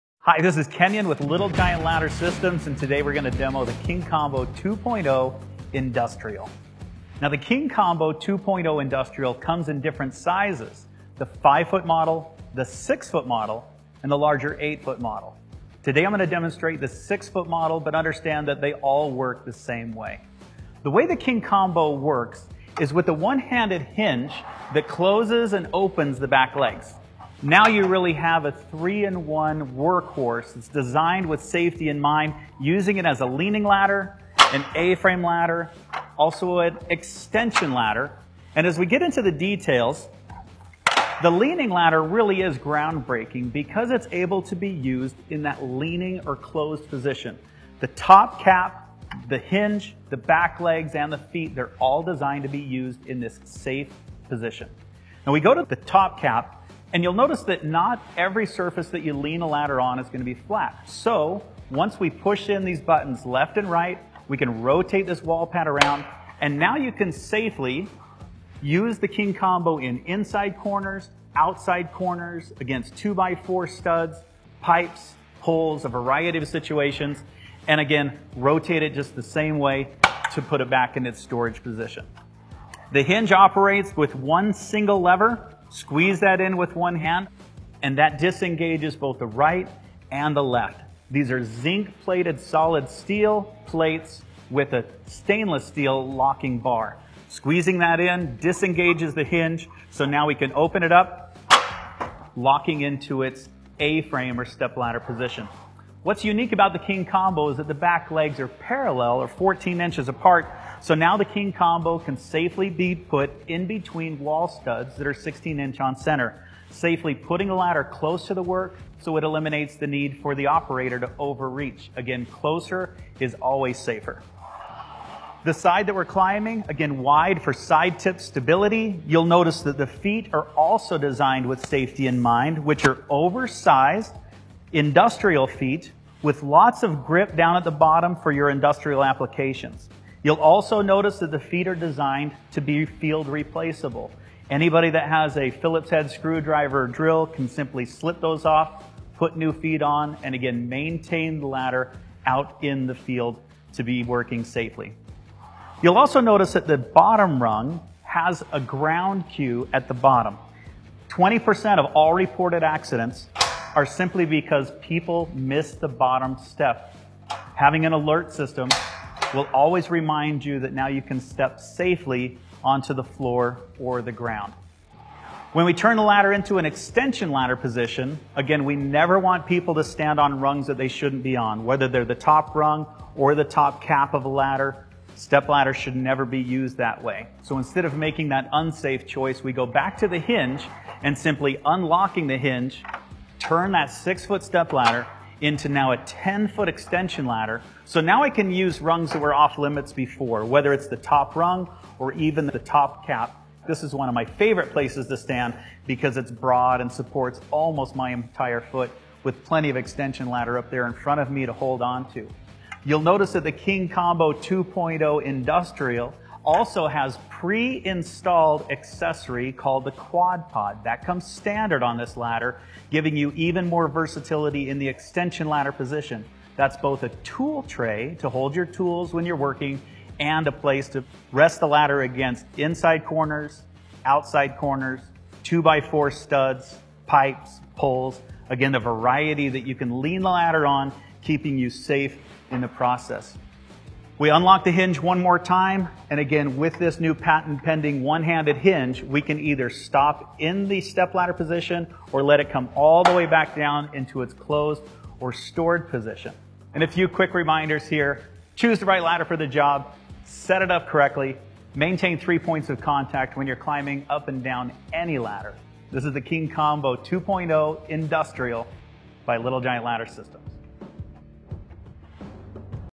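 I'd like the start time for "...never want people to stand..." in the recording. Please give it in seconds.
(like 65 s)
178 s.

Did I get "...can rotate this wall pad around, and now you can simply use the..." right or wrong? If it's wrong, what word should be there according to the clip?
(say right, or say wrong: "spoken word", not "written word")
wrong: "safely", not "simply".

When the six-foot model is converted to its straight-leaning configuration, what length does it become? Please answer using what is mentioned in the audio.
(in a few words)
10 foot.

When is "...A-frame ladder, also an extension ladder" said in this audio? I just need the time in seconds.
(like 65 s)
34 s.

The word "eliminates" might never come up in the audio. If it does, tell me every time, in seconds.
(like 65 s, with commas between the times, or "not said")
119 s.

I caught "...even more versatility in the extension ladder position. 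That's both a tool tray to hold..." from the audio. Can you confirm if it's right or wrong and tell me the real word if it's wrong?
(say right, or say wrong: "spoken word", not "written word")
right.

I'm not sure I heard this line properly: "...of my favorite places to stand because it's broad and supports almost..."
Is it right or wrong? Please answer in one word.
right.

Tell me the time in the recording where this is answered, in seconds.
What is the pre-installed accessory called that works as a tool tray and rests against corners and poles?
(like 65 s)
219 s.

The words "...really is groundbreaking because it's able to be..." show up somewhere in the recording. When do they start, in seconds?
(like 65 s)
42 s.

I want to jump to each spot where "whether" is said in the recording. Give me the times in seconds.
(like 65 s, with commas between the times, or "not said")
181 s, 200 s.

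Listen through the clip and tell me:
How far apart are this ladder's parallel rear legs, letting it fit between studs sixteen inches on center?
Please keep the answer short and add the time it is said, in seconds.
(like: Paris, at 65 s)
14 inches, at 109 s.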